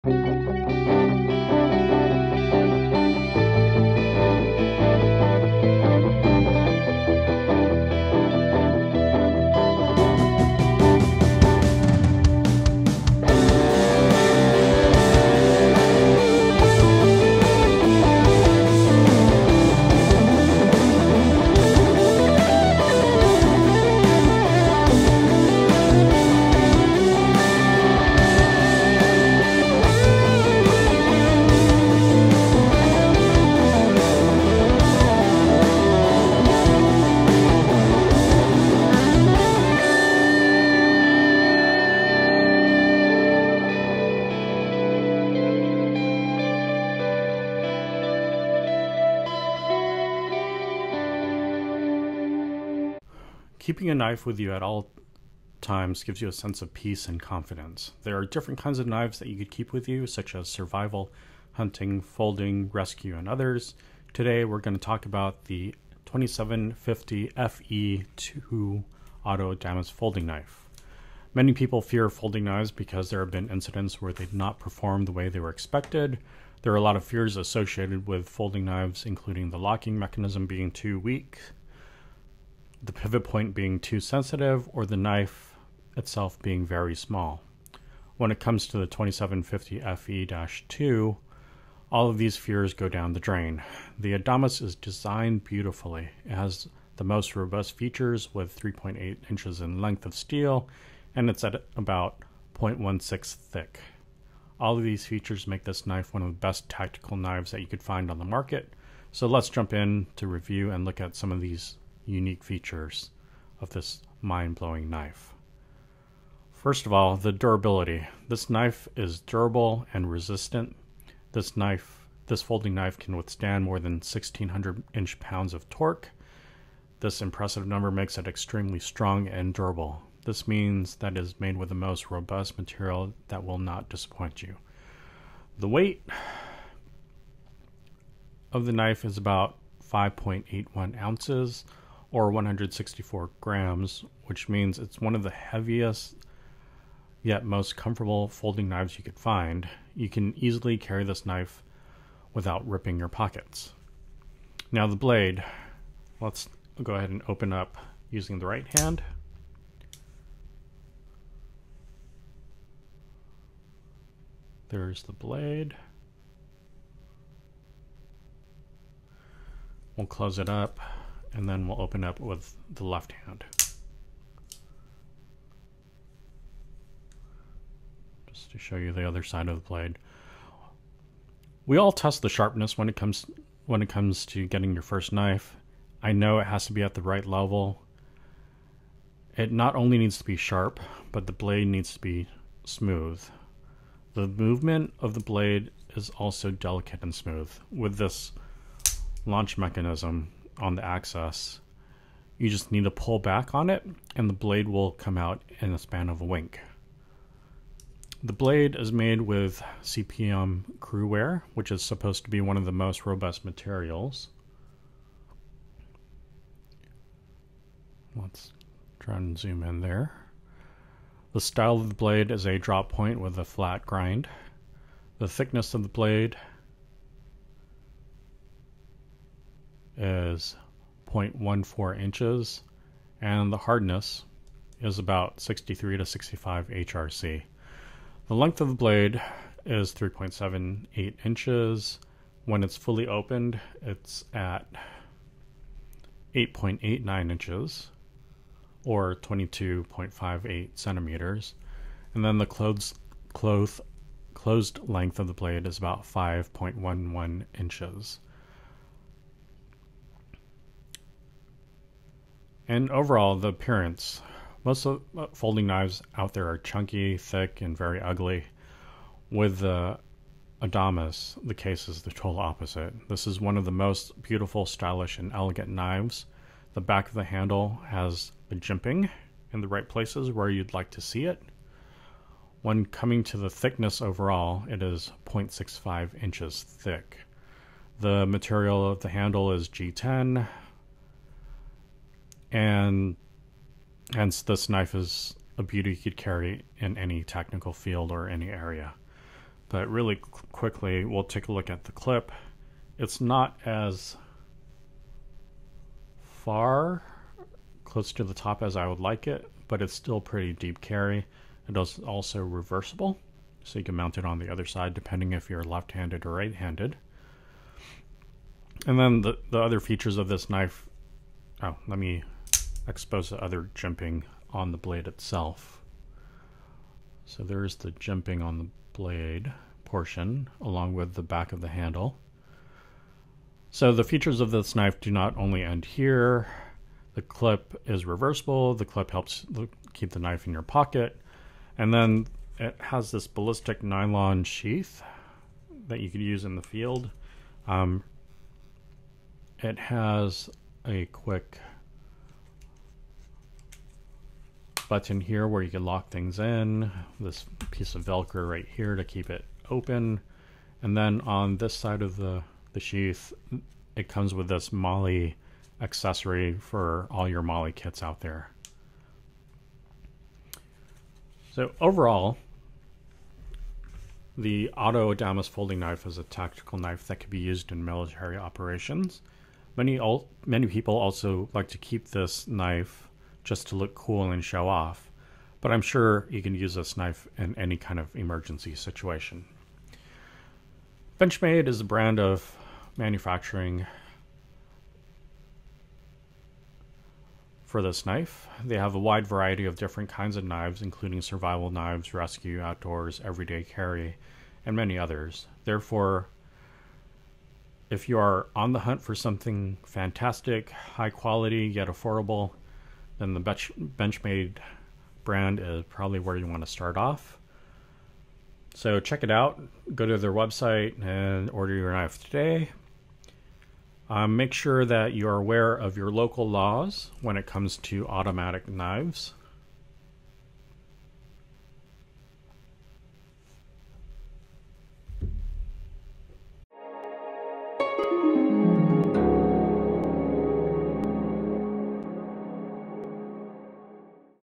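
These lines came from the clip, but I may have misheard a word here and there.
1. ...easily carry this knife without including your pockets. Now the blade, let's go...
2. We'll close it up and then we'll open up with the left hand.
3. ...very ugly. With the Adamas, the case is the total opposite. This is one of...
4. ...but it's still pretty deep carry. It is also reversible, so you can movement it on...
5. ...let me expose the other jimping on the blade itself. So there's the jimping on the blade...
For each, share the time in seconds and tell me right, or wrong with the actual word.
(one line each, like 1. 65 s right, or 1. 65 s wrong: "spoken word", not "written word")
1. 150 s wrong: "ripping", not "including"
2. 169 s right
3. 267 s right
4. 309 s wrong: "mount", not "movement"
5. 321 s right.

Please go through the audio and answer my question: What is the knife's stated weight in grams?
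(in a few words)
164 grams.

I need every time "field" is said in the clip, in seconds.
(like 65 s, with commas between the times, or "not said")
297 s, 346 s.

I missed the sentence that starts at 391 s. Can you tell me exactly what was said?
Benchmade is a brand of manufacturing for this knife.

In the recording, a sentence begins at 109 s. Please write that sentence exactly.
So let's jump in to review and look at some of these unique features of this mind-blowing knife.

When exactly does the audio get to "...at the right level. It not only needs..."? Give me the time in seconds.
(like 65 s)
186 s.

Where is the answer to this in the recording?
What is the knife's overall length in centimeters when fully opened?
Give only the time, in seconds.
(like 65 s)
249 s.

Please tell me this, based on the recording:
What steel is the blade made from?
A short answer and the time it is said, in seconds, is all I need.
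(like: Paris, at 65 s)
CPM CruWear, at 209 s.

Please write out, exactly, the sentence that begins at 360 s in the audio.
And then on this side of the, the sheath, it comes with this MOLLE accessory for all your MOLLE kits out there.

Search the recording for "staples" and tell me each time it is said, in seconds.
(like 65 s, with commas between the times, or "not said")
not said.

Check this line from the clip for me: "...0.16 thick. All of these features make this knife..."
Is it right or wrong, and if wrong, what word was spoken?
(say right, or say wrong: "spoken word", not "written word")
right.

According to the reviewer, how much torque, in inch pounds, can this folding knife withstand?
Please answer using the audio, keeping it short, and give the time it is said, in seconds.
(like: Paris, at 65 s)
1600, at 123 s.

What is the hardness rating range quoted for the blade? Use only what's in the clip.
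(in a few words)
63 to 65 HRC.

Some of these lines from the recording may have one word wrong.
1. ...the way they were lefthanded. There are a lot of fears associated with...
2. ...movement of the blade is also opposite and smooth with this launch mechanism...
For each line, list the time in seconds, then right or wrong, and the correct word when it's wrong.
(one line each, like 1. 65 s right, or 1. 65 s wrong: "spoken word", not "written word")
1. 75 s wrong: "expected", not "lefthanded"
2. 194 s wrong: "delicate", not "opposite".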